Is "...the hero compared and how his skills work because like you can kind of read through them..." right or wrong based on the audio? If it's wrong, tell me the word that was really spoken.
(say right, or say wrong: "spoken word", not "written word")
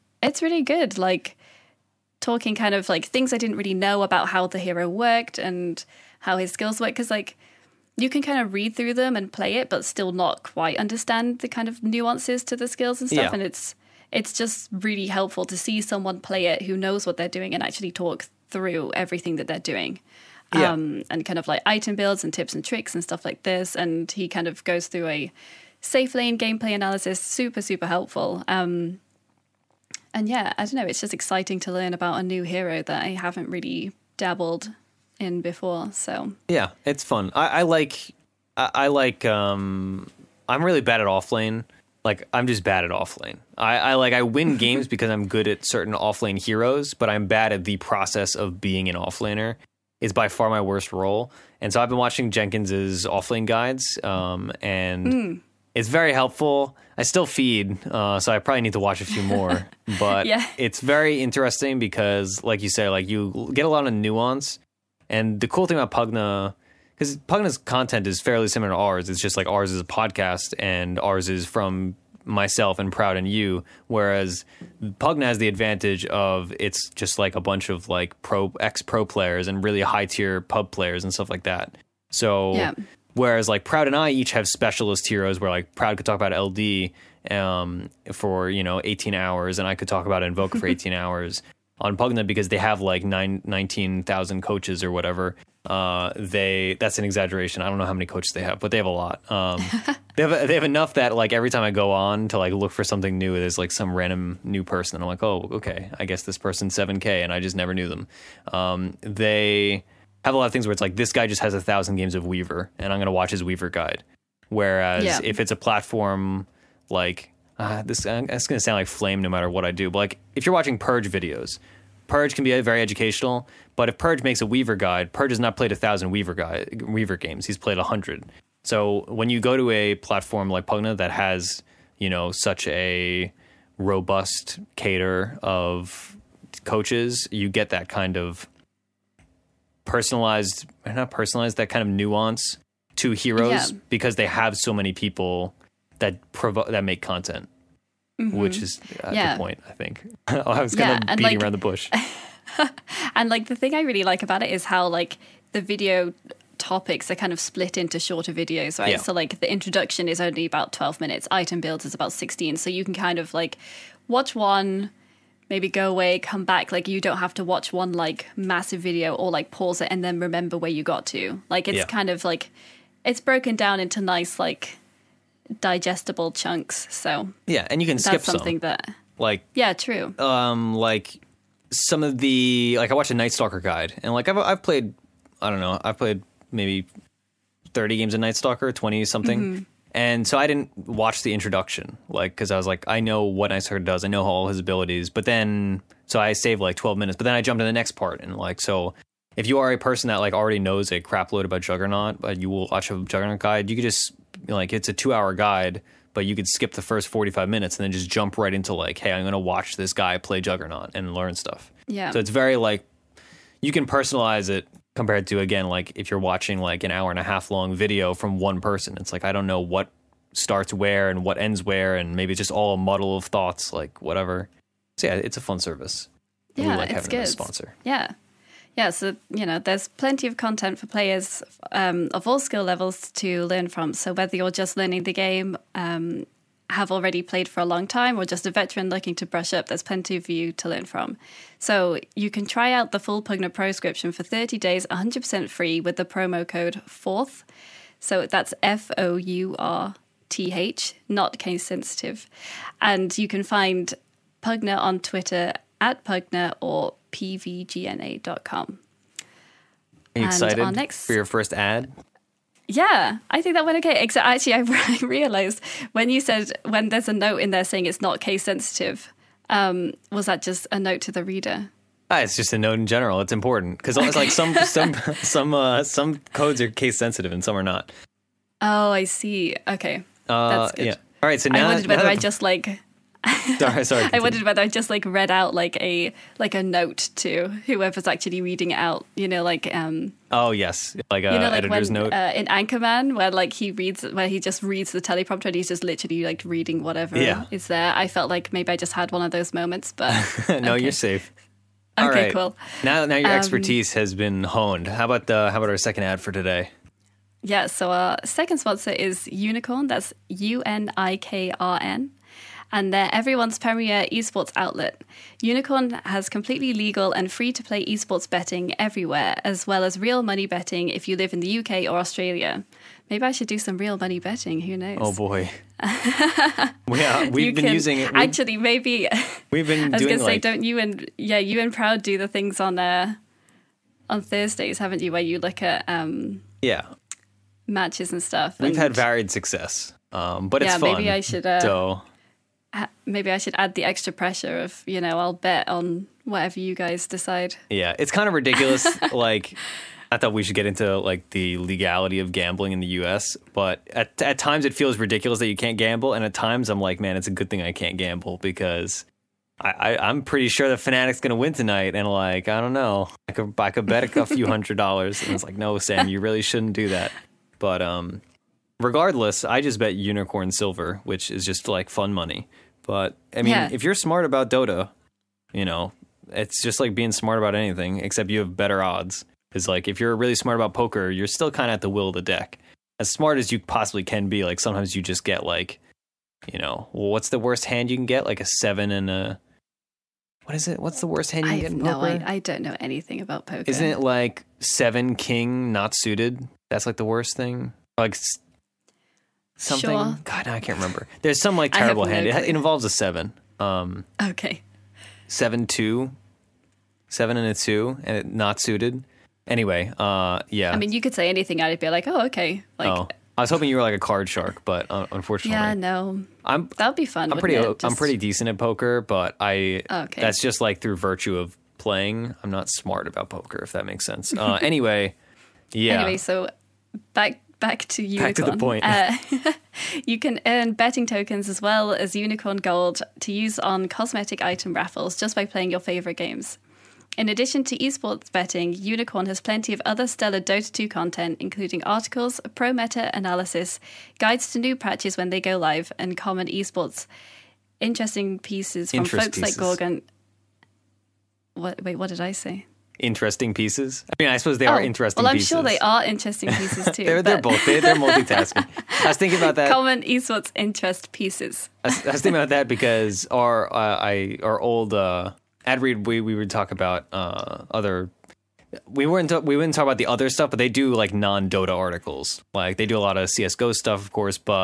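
wrong: "worked", not "compared".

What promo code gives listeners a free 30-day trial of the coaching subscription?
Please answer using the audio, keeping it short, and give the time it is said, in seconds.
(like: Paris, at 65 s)
FOURTH, at 245 s.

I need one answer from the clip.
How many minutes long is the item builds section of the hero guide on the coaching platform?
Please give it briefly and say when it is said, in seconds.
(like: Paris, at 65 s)
16, at 161 s.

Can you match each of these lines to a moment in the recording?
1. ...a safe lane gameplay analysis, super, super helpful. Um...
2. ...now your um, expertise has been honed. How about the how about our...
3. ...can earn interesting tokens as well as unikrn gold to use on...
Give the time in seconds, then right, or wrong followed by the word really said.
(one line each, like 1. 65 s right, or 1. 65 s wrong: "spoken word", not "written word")
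1. 25 s right
2. 303 s right
3. 430 s wrong: "betting", not "interesting".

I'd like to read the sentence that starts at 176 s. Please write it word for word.
So yeah, and you can skip something some.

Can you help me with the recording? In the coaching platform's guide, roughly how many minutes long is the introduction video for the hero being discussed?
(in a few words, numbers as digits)
12.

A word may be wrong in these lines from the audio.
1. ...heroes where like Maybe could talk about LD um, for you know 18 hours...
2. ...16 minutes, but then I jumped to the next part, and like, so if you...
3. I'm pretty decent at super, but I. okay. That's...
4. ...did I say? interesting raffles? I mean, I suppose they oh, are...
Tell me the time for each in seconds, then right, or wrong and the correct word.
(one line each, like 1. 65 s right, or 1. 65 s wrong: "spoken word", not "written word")
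1. 85 s wrong: "Proud", not "Maybe"
2. 196 s wrong: "12", not "16"
3. 417 s wrong: "poker", not "super"
4. 452 s wrong: "pieces", not "raffles".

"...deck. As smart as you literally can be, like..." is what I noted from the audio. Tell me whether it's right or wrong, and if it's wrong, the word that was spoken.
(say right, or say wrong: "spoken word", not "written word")
wrong: "possibly", not "literally".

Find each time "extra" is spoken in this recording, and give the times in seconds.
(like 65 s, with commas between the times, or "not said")
343 s.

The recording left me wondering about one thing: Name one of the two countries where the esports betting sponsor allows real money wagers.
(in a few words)
UK or Australia.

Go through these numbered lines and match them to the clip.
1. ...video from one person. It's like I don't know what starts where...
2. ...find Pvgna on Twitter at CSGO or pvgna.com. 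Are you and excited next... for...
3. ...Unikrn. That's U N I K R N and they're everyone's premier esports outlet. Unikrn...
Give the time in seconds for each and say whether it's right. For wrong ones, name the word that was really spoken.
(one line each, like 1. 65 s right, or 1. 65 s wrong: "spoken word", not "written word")
1. 217 s right
2. 253 s wrong: "Pvgna", not "CSGO"
3. 309 s right.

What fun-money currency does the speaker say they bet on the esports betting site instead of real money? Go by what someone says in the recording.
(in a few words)
Unikrn silver.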